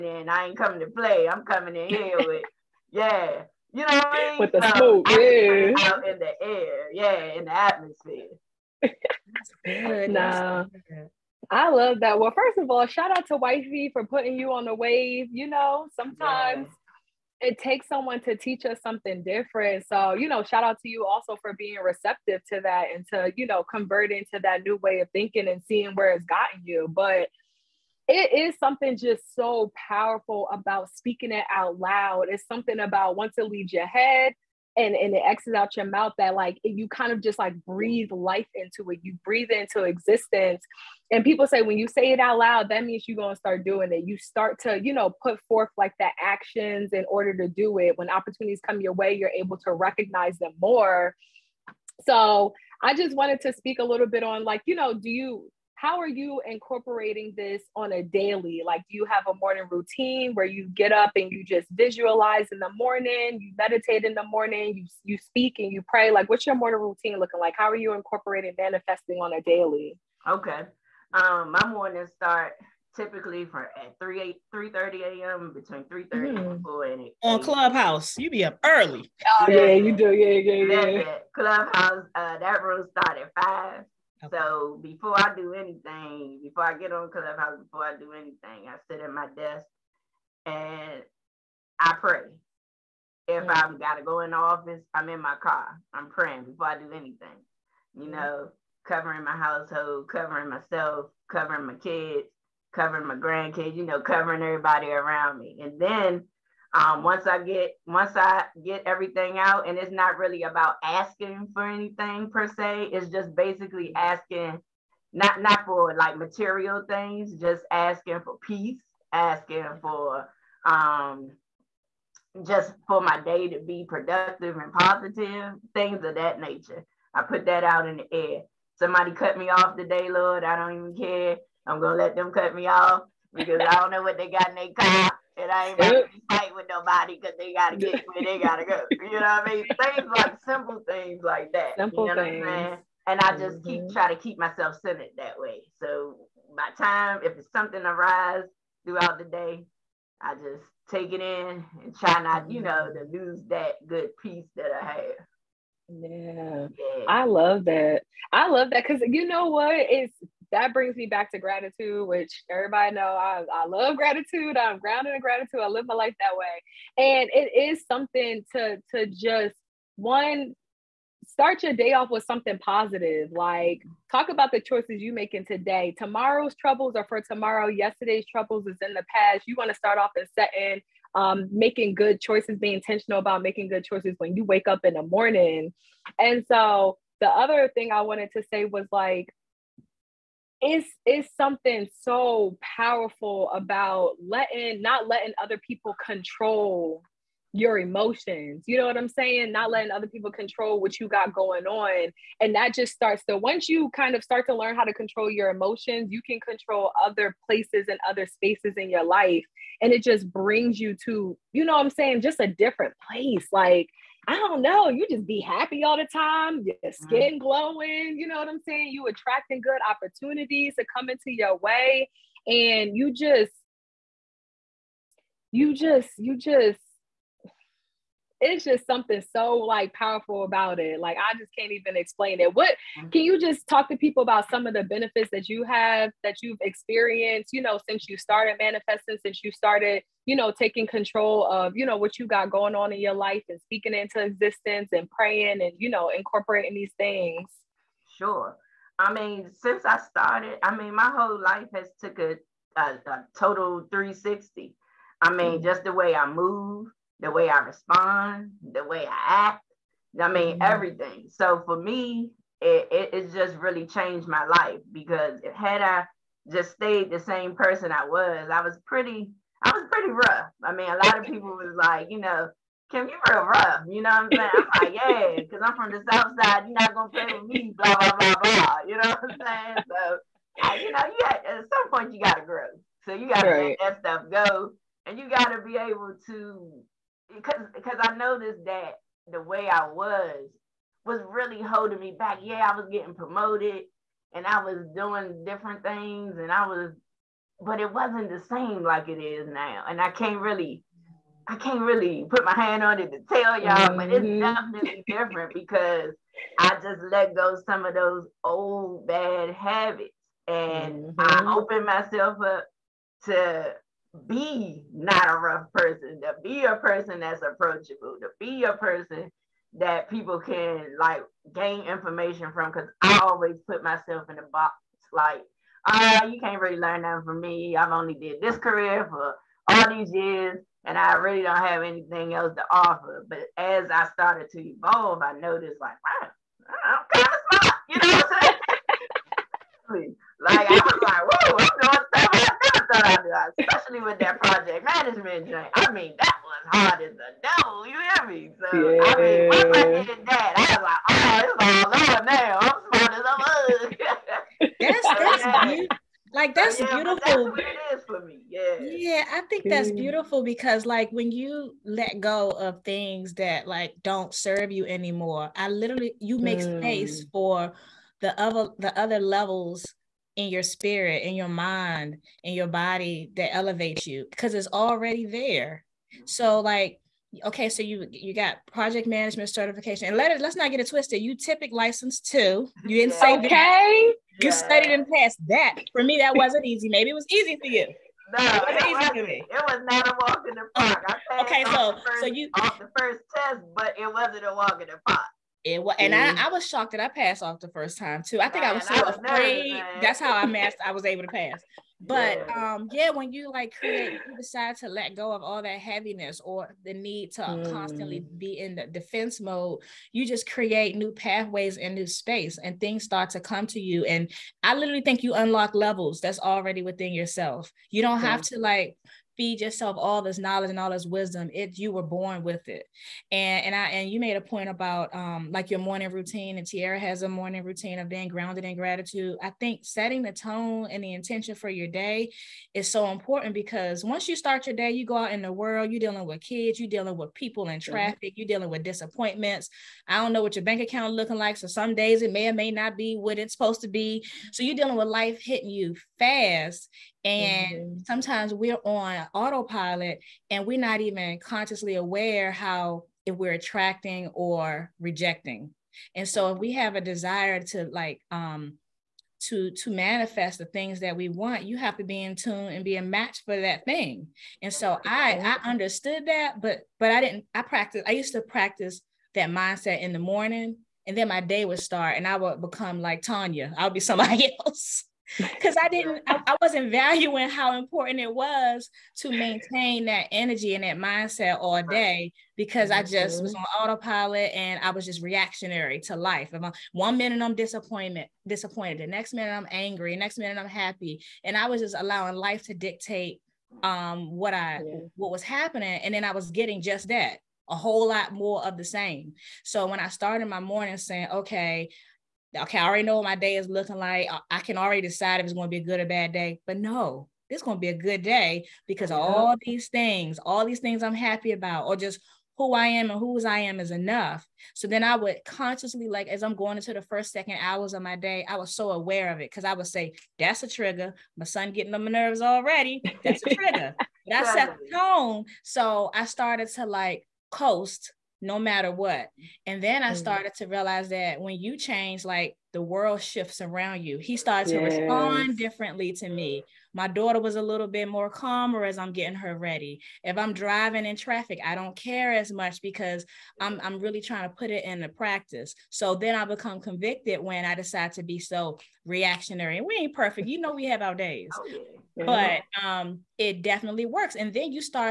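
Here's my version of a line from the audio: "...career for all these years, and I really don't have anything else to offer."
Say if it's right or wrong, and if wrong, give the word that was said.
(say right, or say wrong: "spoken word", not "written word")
right.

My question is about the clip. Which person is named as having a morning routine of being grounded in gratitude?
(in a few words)
Tiara.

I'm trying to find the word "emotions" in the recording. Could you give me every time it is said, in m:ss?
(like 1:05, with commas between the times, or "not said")
3:17, 3:25.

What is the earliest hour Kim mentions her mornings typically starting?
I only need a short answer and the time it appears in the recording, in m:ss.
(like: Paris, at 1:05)
3 a.m., at 1:13.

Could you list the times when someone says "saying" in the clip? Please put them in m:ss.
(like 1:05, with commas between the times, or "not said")
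3:19, 3:31, 3:38, 4:34, 4:39, 5:39, 8:20.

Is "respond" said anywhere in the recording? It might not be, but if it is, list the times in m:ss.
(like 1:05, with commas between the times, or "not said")
4:17, 8:55.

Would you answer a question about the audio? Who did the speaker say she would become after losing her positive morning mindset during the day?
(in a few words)
Tanya.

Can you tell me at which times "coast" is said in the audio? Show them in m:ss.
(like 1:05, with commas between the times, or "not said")
8:47.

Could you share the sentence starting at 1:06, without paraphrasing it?
Like, what's your morning routine looking like?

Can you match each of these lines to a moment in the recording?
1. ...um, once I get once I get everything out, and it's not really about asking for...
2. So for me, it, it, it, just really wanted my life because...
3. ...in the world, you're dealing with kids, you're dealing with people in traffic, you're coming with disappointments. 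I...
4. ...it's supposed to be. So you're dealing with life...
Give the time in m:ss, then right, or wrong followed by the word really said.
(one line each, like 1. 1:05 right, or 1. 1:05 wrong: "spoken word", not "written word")
1. 1:46 right
2. 4:21 wrong: "changed", not "wanted"
3. 7:15 wrong: "dealing", not "coming"
4. 7:23 right.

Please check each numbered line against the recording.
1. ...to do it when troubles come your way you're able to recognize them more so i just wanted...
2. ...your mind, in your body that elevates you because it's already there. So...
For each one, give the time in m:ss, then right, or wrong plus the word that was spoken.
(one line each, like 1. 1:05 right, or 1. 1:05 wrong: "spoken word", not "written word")
1. 0:47 wrong: "opportunities", not "troubles"
2. 6:11 right.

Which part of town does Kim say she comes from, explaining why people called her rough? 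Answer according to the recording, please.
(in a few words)
South Side.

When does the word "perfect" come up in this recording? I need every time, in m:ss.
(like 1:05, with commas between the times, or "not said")
9:10.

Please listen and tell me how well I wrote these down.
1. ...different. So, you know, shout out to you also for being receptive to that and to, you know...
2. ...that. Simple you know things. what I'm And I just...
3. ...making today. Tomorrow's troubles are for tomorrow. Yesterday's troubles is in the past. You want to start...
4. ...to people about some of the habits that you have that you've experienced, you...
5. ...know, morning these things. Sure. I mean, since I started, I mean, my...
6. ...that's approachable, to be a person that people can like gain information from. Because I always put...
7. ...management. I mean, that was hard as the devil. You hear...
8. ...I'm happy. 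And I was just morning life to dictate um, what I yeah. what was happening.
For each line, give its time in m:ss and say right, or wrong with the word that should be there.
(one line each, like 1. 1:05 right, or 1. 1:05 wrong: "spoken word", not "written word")
1. 0:19 right
2. 2:21 right
3. 2:55 right
4. 3:53 wrong: "benefits", not "habits"
5. 4:05 wrong: "incorporating", not "morning"
6. 5:17 right
7. 5:45 wrong: "joint", not "management"
8. 8:10 wrong: "allowing", not "morning".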